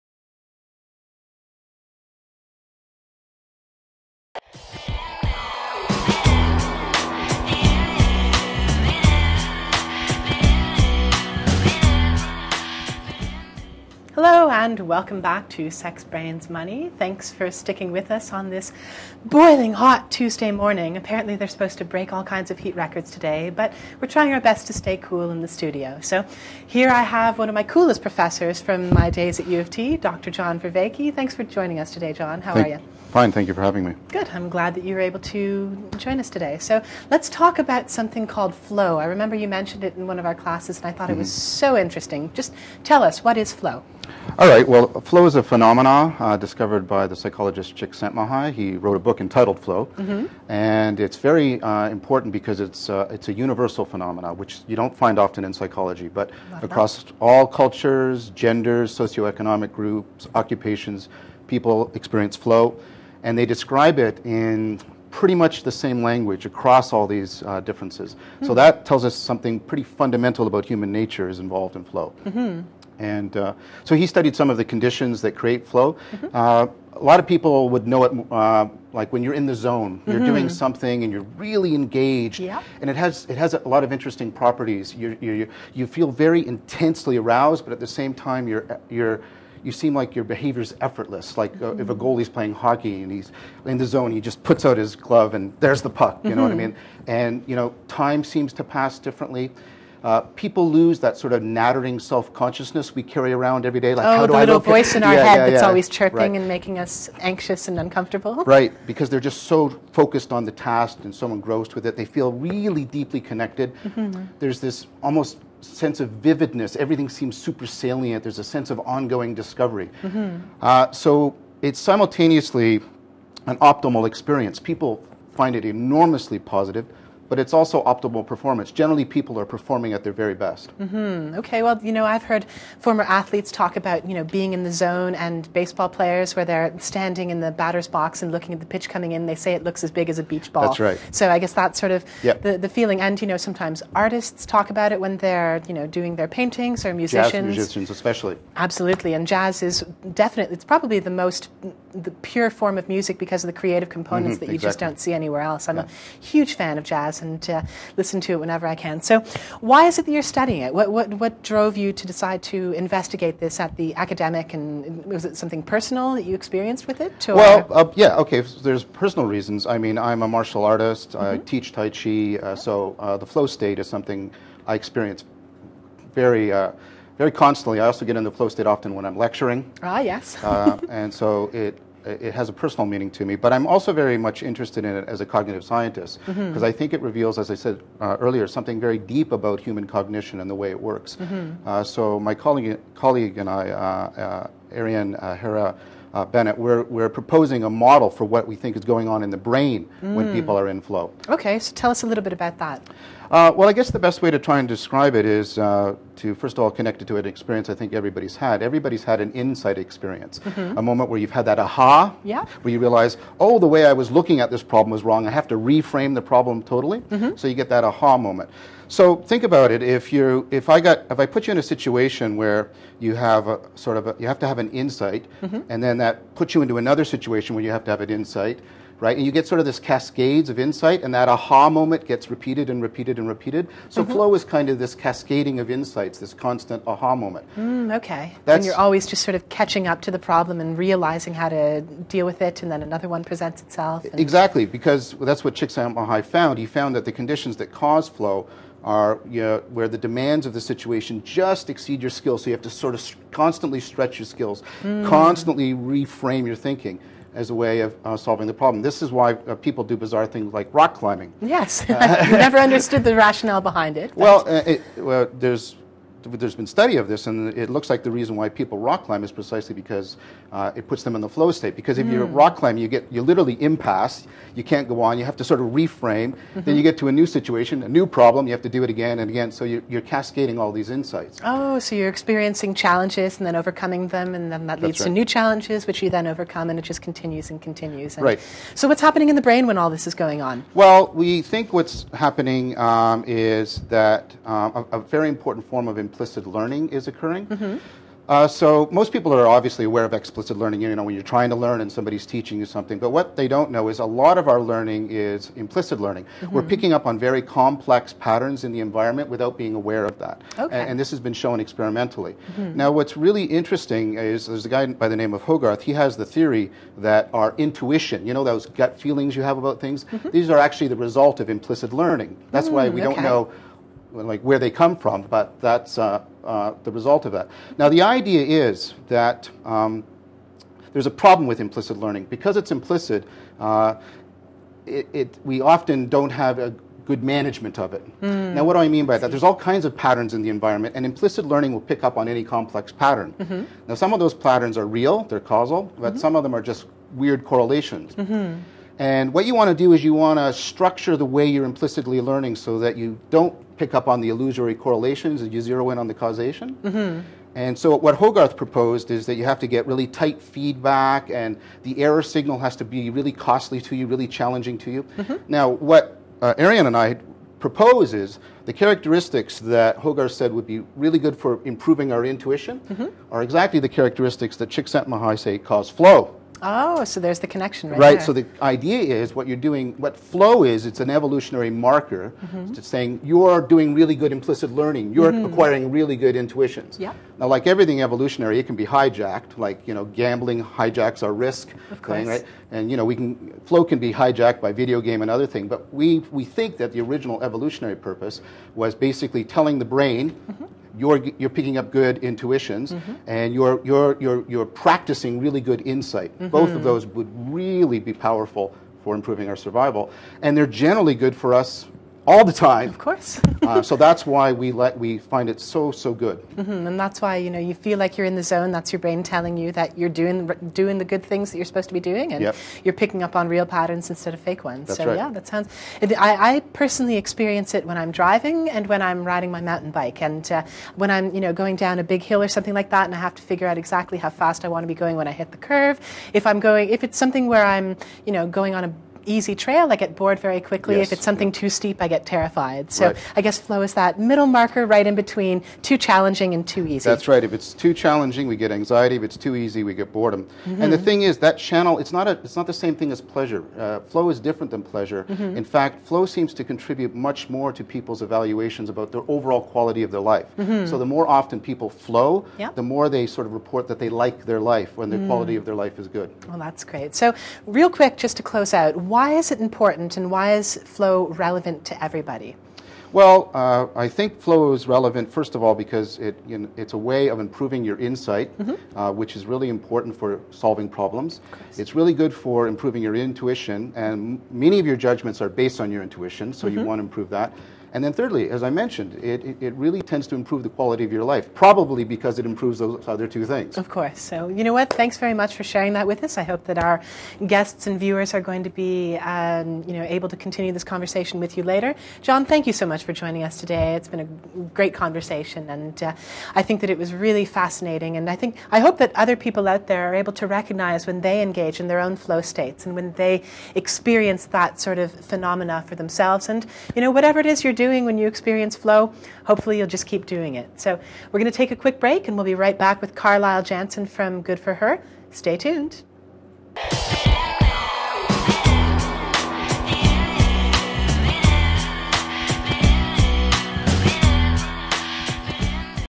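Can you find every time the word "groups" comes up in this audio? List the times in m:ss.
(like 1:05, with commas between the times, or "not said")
0:59.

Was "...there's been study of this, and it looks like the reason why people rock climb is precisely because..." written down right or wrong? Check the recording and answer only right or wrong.
right.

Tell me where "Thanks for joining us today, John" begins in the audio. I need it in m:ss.
0:31.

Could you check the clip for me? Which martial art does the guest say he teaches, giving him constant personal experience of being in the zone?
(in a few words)
Tai Chi.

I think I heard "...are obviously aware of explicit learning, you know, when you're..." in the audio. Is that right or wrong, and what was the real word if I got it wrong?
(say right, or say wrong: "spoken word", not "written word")
right.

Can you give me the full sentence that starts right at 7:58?
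uh, which is really important for solving problems.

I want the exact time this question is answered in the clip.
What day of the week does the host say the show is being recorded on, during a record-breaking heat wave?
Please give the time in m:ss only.
0:20.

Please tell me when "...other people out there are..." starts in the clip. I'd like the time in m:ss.
8:29.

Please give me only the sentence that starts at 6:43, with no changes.
and you're, you're, you're, you're practicing really good insight.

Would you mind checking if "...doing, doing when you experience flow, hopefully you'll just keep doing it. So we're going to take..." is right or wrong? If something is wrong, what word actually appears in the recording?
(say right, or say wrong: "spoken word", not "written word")
right.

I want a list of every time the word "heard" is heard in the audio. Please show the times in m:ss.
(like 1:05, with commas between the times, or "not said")
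2:12.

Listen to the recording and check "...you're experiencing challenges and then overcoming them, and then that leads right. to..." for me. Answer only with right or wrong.
right.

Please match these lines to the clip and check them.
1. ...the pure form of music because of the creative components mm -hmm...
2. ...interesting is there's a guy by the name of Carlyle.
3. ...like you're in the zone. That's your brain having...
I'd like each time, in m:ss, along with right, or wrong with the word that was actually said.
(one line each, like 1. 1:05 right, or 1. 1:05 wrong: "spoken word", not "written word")
1. 2:32 right
2. 5:13 wrong: "Hogarth", not "Carlyle"
3. 6:57 wrong: "telling", not "having".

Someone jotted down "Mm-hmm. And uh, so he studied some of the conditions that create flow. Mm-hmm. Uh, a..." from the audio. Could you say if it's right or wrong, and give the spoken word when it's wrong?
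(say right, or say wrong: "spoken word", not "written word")
right.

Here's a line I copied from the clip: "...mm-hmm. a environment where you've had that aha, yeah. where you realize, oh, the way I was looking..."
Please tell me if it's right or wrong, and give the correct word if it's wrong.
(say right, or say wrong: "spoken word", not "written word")
wrong: "moment", not "environment".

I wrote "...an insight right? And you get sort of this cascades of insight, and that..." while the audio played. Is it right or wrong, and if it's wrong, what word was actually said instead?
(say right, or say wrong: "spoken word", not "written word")
right.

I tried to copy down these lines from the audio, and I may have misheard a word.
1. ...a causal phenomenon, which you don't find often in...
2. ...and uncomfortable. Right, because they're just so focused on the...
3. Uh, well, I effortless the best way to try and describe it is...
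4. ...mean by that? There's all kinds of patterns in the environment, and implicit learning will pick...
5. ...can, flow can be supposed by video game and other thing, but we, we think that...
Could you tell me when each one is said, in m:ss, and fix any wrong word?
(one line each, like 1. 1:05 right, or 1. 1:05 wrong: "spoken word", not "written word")
1. 0:53 wrong: "universal", not "causal"
2. 1:47 right
3. 3:23 wrong: "guess", not "effortless"
4. 5:38 right
5. 6:33 wrong: "hijacked", not "supposed".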